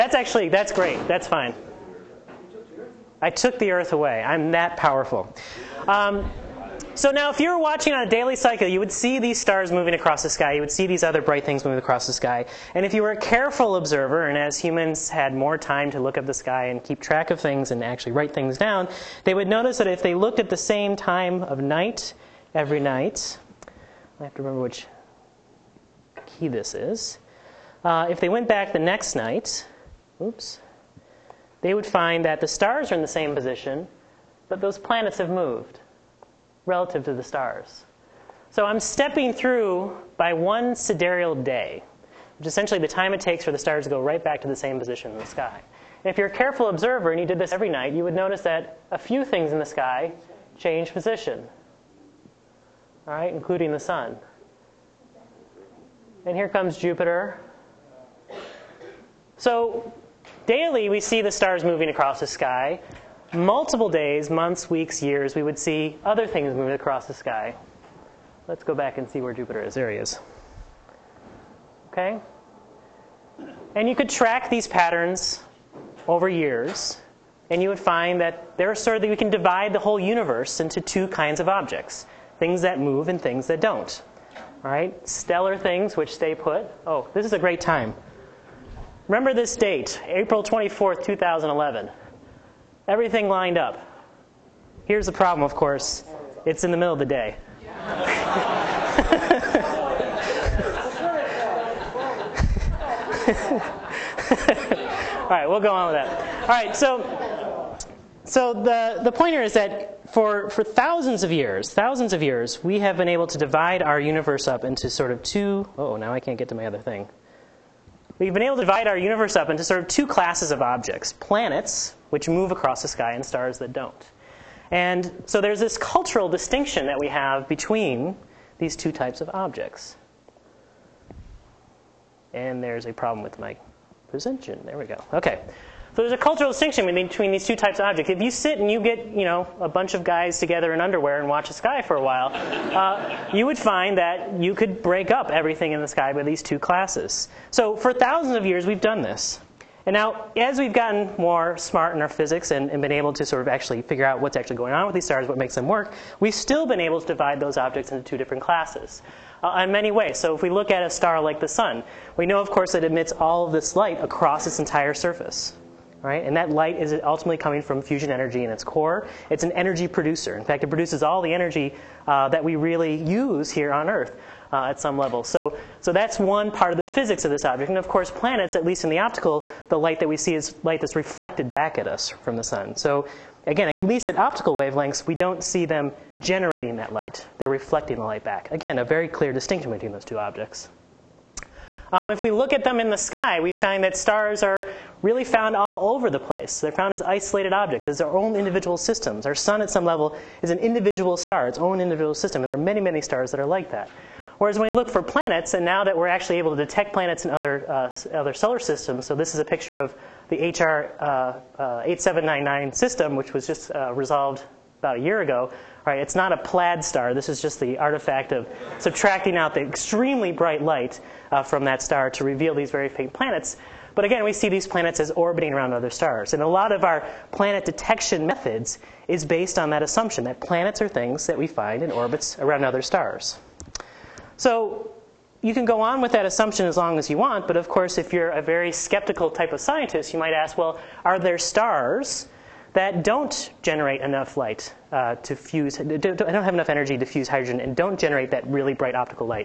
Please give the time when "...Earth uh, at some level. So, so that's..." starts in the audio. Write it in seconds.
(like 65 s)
173 s.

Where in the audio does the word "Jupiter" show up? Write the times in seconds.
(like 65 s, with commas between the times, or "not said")
56 s, 69 s.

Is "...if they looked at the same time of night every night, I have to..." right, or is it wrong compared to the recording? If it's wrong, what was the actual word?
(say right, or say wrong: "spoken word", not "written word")
right.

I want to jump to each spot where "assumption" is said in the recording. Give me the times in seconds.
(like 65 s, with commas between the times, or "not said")
229 s, 236 s.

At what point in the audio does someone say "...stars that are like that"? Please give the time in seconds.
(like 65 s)
202 s.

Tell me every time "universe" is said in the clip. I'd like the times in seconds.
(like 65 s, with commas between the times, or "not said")
79 s, 113 s, 118 s.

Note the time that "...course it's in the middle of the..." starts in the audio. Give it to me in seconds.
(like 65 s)
95 s.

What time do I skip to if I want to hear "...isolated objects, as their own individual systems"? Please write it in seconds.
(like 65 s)
197 s.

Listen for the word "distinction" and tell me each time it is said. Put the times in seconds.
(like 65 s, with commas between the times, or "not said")
126 s, 136 s, 189 s.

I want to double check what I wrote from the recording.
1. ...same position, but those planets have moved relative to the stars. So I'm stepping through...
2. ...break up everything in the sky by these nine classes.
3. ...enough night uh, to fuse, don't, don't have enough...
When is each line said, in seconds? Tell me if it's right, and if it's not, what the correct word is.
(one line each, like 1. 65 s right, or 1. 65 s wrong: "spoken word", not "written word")
1. 33 s right
2. 144 s wrong: "two", not "nine"
3. 244 s wrong: "light", not "night".